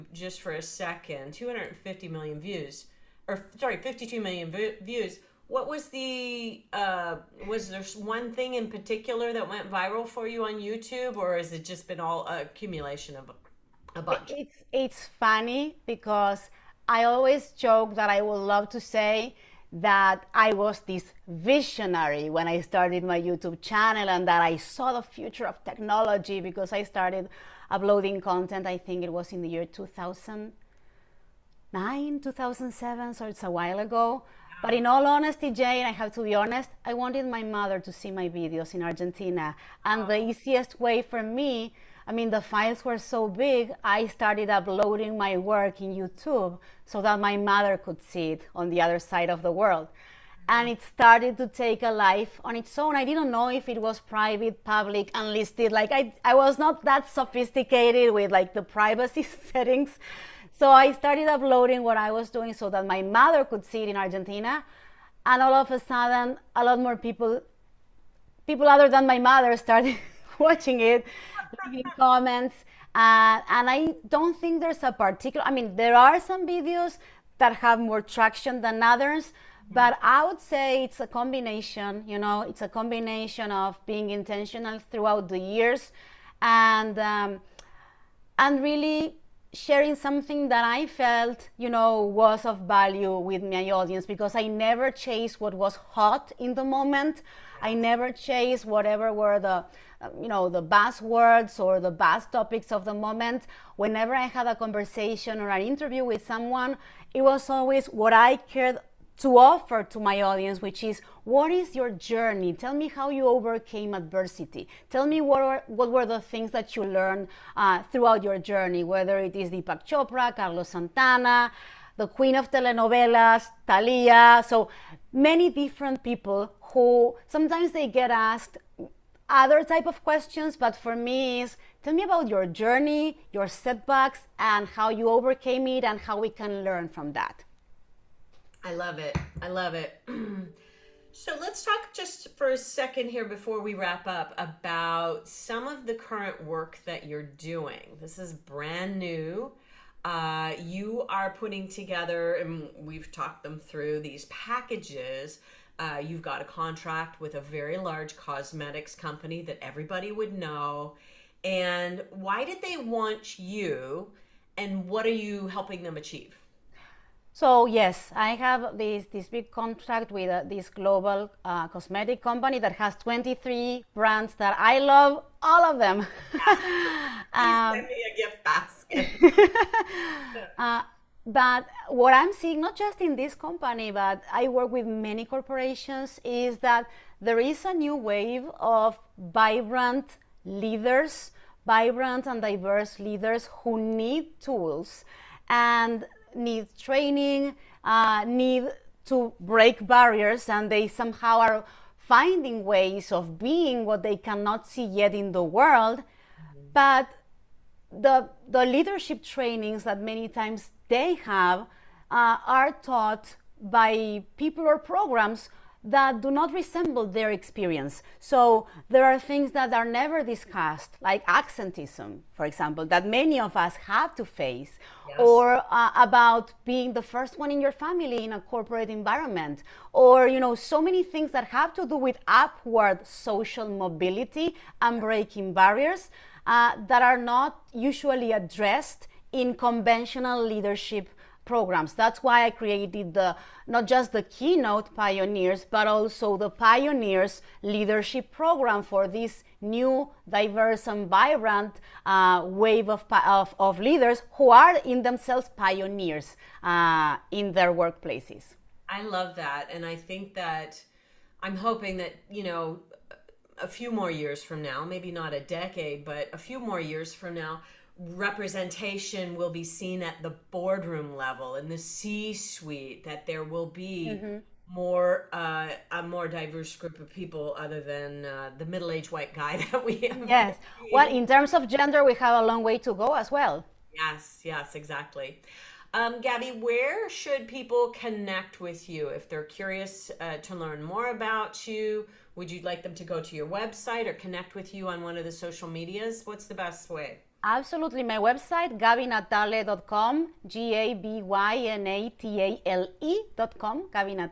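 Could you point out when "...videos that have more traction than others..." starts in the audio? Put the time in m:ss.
1:16.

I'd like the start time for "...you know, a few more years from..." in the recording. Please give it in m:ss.
4:22.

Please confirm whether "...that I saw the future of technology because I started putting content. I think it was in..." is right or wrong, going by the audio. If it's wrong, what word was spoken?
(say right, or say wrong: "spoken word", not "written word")
wrong: "uploading", not "putting".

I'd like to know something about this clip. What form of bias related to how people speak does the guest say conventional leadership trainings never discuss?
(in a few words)
Accentism.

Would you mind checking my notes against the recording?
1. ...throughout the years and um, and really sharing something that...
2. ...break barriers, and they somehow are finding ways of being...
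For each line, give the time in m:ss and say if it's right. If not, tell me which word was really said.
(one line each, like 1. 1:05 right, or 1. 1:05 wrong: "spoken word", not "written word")
1. 1:24 right
2. 3:19 right.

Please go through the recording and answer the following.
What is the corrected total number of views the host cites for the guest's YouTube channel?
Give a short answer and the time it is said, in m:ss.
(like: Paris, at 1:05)
52 million, at 0:03.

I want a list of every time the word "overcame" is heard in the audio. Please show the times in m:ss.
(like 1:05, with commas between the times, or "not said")
1:53, 2:15.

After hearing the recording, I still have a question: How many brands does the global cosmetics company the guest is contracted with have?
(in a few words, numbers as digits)
23.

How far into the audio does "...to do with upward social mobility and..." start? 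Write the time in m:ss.
3:51.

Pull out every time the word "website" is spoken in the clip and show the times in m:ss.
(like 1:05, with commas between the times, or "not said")
4:53, 4:58.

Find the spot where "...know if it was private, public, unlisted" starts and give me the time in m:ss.
0:53.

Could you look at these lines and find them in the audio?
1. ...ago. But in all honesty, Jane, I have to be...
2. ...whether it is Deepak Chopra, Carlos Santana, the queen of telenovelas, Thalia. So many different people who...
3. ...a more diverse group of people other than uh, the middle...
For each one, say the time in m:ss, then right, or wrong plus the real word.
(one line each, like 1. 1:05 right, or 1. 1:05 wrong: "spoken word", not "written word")
1. 0:33 right
2. 1:58 right
3. 4:35 right.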